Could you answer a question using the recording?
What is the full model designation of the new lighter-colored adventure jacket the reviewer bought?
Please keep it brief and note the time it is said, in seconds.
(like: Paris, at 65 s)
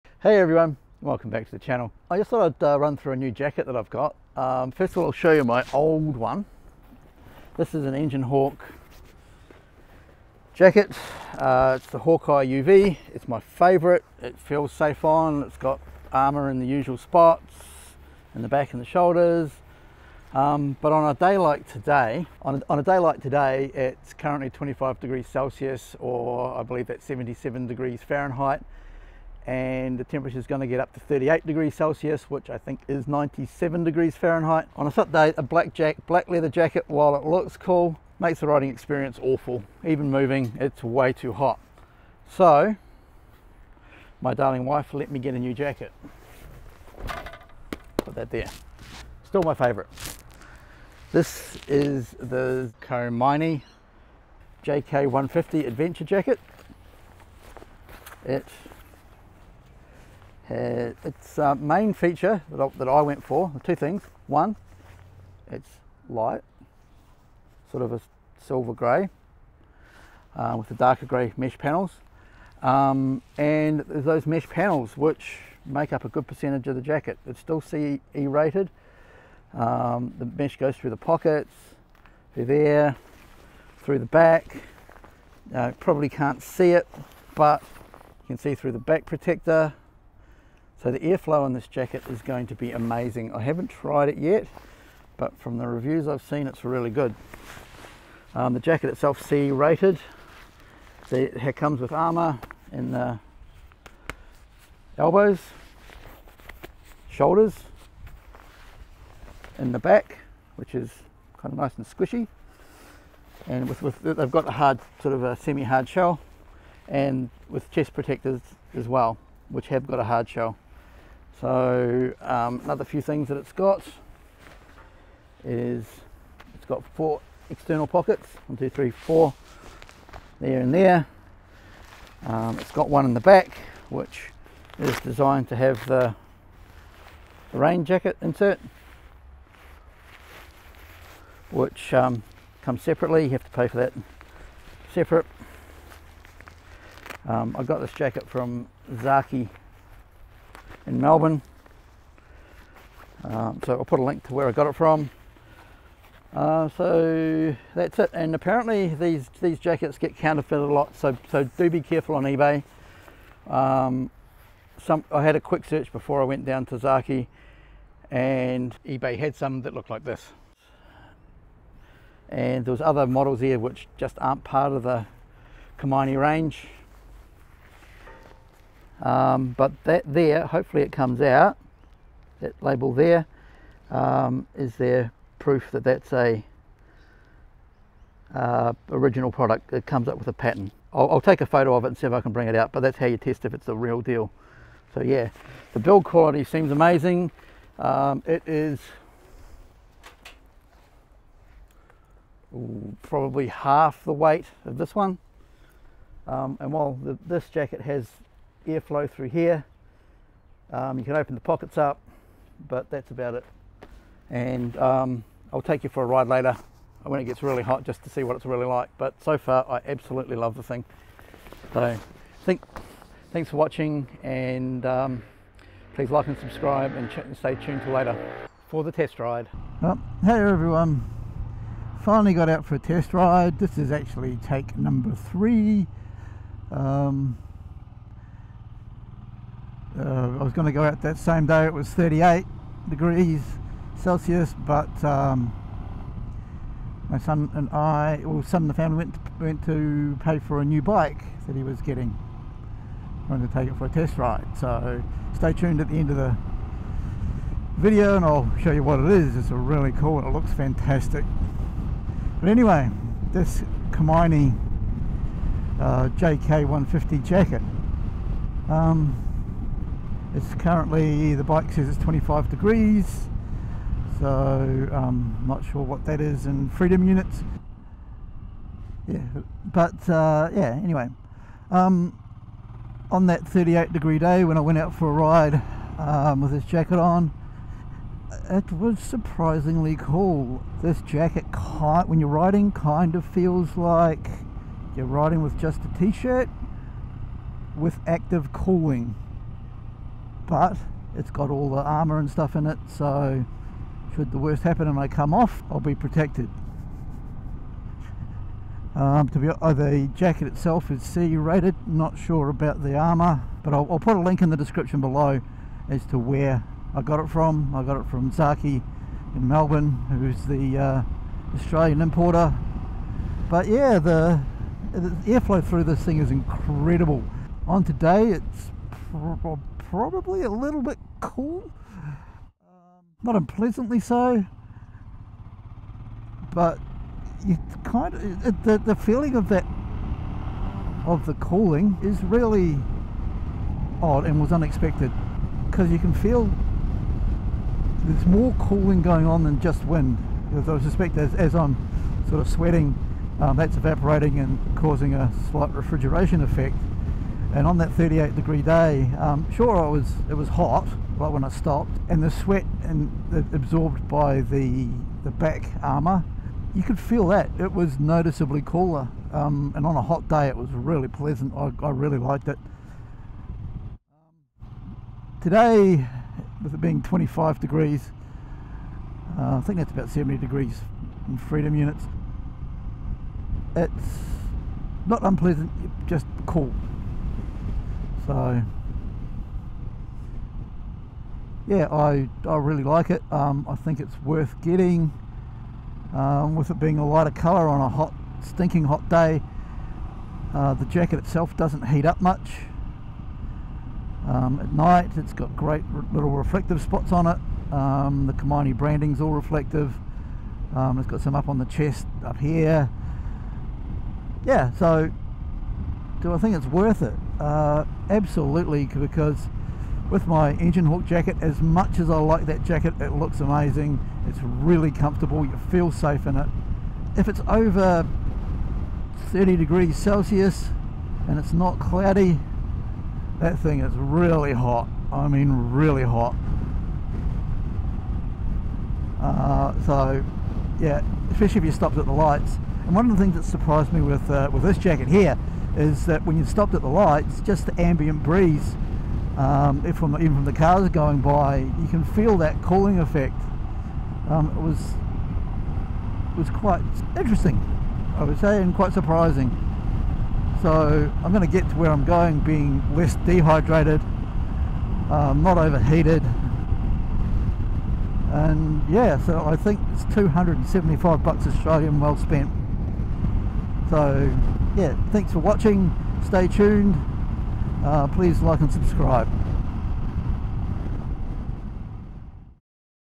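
Komine JK150, at 52 s.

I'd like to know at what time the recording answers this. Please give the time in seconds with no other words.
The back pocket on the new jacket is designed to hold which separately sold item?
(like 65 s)
137 s.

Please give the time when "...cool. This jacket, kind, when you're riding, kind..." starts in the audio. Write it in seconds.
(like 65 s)
289 s.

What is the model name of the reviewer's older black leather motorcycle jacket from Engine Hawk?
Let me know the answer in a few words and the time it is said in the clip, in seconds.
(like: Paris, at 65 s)
Hawkeye UV, at 11 s.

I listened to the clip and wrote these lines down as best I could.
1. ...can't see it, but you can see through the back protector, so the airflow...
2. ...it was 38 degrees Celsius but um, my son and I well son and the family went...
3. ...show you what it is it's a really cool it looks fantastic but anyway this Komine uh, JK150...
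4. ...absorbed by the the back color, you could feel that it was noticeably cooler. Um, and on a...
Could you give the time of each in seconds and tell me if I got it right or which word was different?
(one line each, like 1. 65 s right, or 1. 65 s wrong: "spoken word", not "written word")
1. 86 s right
2. 241 s right
3. 258 s right
4. 363 s wrong: "armor", not "color".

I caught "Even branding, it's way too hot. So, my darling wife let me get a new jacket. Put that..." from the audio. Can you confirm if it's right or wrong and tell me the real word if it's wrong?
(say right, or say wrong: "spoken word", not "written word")
wrong: "moving", not "branding".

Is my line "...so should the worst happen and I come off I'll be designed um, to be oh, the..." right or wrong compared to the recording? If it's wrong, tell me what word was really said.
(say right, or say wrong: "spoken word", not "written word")
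wrong: "protected", not "designed".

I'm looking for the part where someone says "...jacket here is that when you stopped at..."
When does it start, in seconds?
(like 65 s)
444 s.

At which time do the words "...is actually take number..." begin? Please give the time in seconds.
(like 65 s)
233 s.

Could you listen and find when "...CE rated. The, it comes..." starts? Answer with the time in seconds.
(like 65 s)
99 s.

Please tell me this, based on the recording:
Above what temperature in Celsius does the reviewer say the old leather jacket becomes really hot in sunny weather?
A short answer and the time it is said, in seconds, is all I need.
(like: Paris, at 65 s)
30 degrees, at 429 s.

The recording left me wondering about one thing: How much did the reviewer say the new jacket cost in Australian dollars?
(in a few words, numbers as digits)
275.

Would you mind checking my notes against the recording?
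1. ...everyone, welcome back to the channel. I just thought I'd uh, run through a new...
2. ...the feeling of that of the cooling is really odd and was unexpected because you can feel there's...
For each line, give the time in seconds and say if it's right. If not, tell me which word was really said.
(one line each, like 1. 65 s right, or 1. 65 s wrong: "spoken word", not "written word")
1. 0 s right
2. 338 s right.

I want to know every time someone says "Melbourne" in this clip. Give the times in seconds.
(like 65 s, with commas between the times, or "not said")
150 s, 319 s.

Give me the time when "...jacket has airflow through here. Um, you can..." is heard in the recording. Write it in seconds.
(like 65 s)
207 s.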